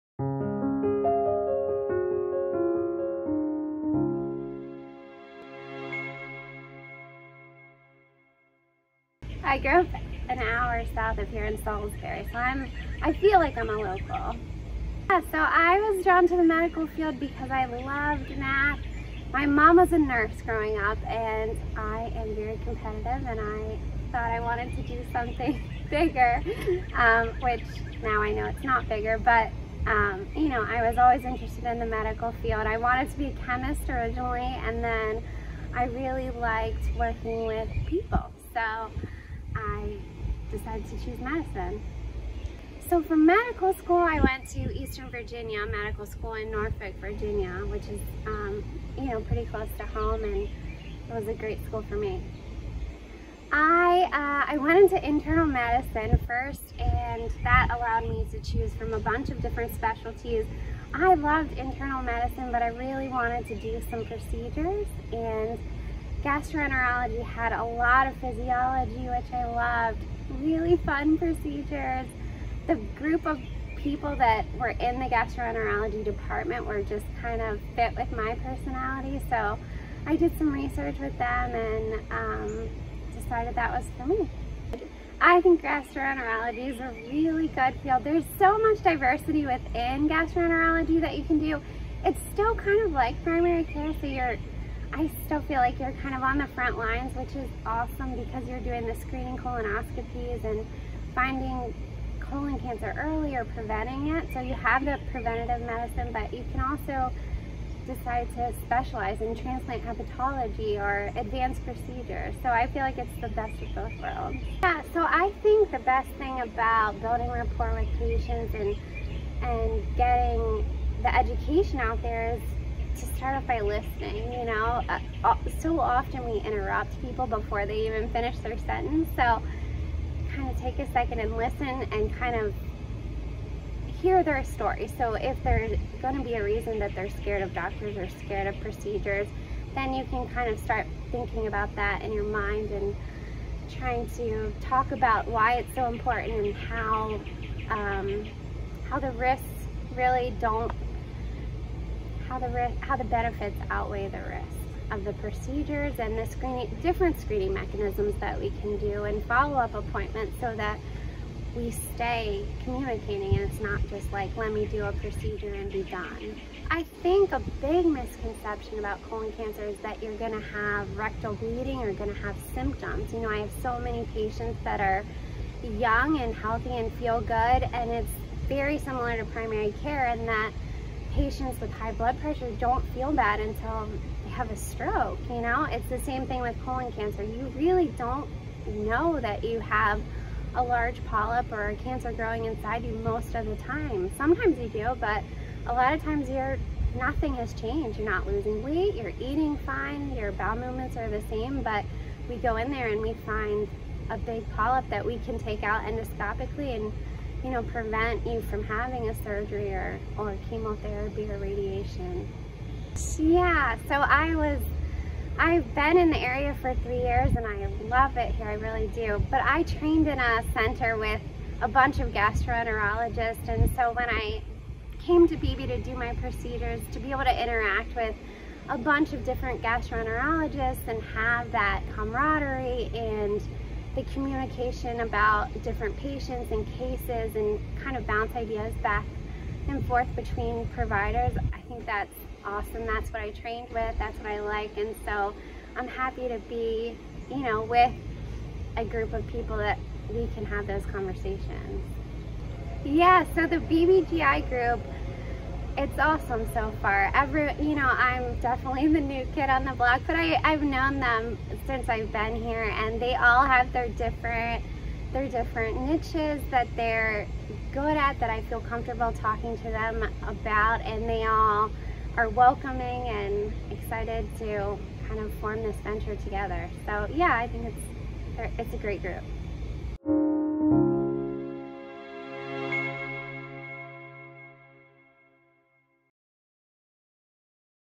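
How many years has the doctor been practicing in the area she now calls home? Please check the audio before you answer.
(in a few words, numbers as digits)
3.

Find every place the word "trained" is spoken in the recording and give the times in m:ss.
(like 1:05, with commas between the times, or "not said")
3:39, 4:03.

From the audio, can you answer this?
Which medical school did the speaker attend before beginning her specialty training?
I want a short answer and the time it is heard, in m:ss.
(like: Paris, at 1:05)
Eastern Virginia Medical School, at 0:44.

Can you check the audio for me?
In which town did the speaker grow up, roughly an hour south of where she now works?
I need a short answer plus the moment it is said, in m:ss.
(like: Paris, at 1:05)
Salisbury, at 0:11.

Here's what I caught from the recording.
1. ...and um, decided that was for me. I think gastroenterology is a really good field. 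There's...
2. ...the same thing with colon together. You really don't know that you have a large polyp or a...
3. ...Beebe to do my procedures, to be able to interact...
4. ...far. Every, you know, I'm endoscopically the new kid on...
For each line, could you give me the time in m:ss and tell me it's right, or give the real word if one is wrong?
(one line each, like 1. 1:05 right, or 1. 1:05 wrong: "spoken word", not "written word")
1. 1:21 right
2. 3:05 wrong: "cancer", not "together"
3. 3:45 right
4. 4:16 wrong: "definitely", not "endoscopically".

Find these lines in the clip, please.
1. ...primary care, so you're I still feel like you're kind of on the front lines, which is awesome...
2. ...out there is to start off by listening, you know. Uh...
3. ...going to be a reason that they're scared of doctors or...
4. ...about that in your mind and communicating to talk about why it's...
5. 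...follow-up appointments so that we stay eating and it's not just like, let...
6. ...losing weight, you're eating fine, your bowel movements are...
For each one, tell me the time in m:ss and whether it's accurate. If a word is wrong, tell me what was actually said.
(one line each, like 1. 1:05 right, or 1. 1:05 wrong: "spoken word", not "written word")
1. 1:33 right
2. 2:01 right
3. 2:16 right
4. 2:21 wrong: "trying", not "communicating"
5. 2:39 wrong: "communicating", not "eating"
6. 3:18 right.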